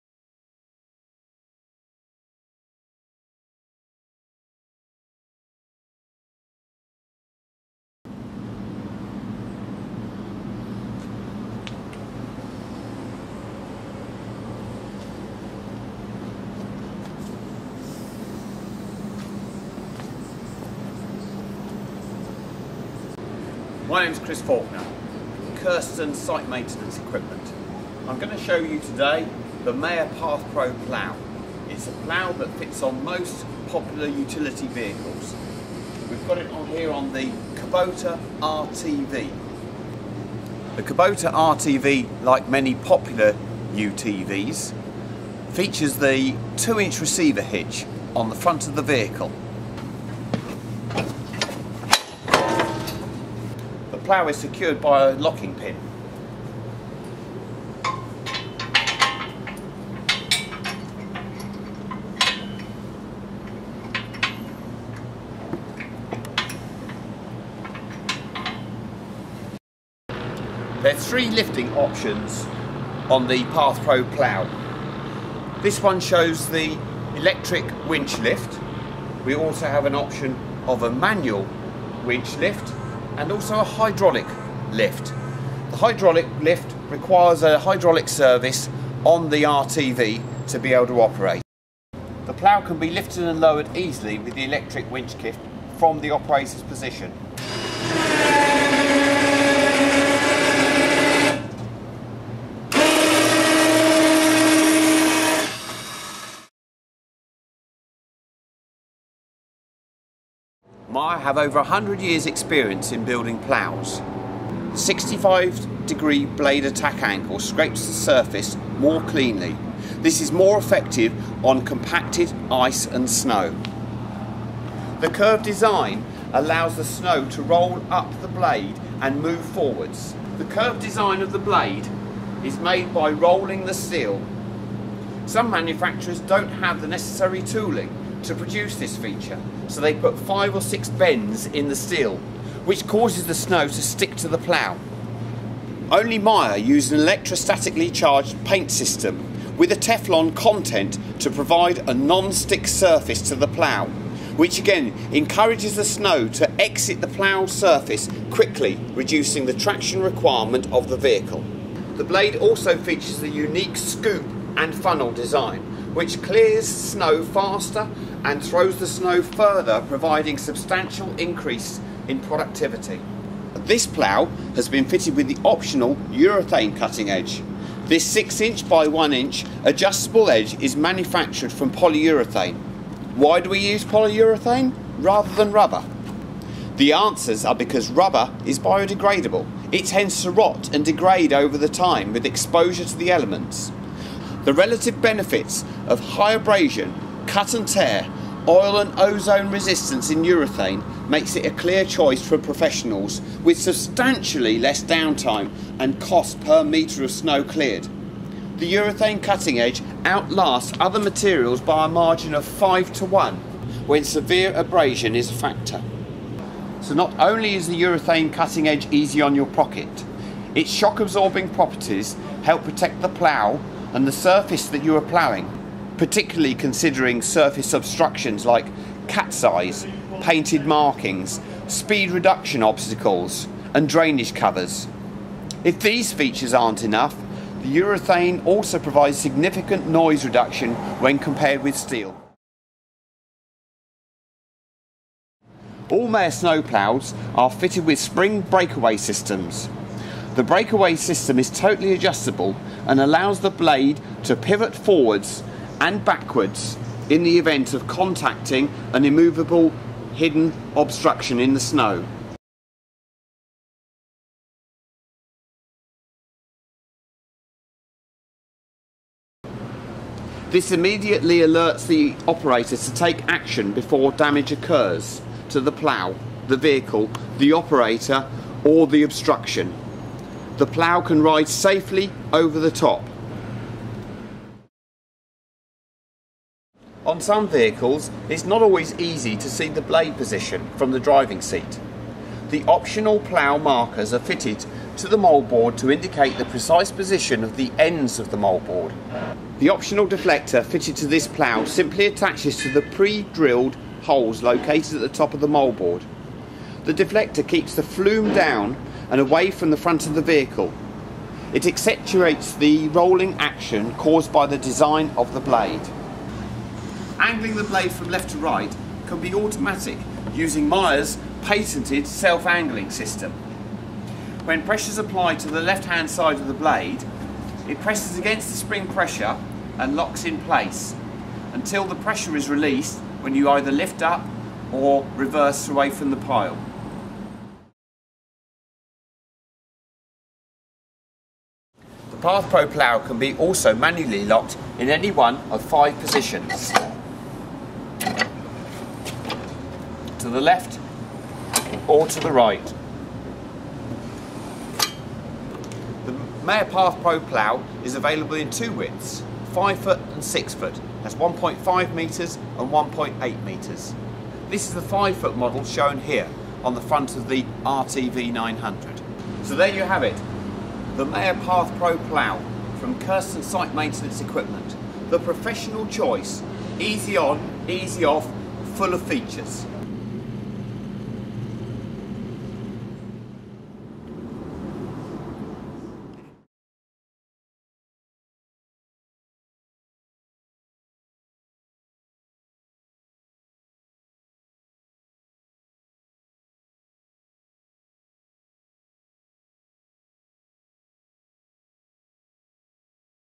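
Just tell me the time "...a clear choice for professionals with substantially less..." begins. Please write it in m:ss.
3:21.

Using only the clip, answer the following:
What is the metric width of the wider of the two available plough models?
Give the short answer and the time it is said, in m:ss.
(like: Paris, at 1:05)
1.8 metres, at 6:02.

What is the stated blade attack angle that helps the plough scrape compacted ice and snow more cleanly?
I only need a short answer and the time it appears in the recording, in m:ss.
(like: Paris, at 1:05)
65 degrees, at 1:54.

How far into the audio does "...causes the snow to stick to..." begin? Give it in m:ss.
2:22.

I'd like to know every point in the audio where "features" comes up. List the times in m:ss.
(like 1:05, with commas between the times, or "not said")
0:45, 2:18, 2:42, 3:56, 6:19.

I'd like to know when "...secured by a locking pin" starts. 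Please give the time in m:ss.
0:54.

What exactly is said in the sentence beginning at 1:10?
There are three lifting options on the PathPro plough.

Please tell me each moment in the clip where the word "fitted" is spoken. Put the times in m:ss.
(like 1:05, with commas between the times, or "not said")
2:54, 4:07, 4:54, 5:00.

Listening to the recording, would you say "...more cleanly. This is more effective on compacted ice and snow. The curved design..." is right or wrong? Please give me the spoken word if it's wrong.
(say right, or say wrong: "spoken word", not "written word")
right.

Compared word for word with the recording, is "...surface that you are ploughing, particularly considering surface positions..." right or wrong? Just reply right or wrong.
wrong.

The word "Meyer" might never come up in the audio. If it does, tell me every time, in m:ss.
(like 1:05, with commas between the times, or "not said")
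0:29, 2:26, 4:06, 5:20, 6:11.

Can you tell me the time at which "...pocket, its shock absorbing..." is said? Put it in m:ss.
3:39.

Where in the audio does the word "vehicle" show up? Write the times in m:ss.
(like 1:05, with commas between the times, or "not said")
0:34, 0:48, 2:40, 4:36, 4:47, 5:10.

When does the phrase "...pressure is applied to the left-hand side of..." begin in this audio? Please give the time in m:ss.
5:24.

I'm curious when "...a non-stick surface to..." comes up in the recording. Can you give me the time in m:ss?
2:31.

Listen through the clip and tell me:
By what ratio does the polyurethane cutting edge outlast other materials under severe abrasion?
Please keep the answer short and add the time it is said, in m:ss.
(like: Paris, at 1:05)
5 to 1, at 3:32.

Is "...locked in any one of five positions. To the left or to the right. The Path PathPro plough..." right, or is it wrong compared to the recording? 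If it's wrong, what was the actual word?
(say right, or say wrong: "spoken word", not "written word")
right.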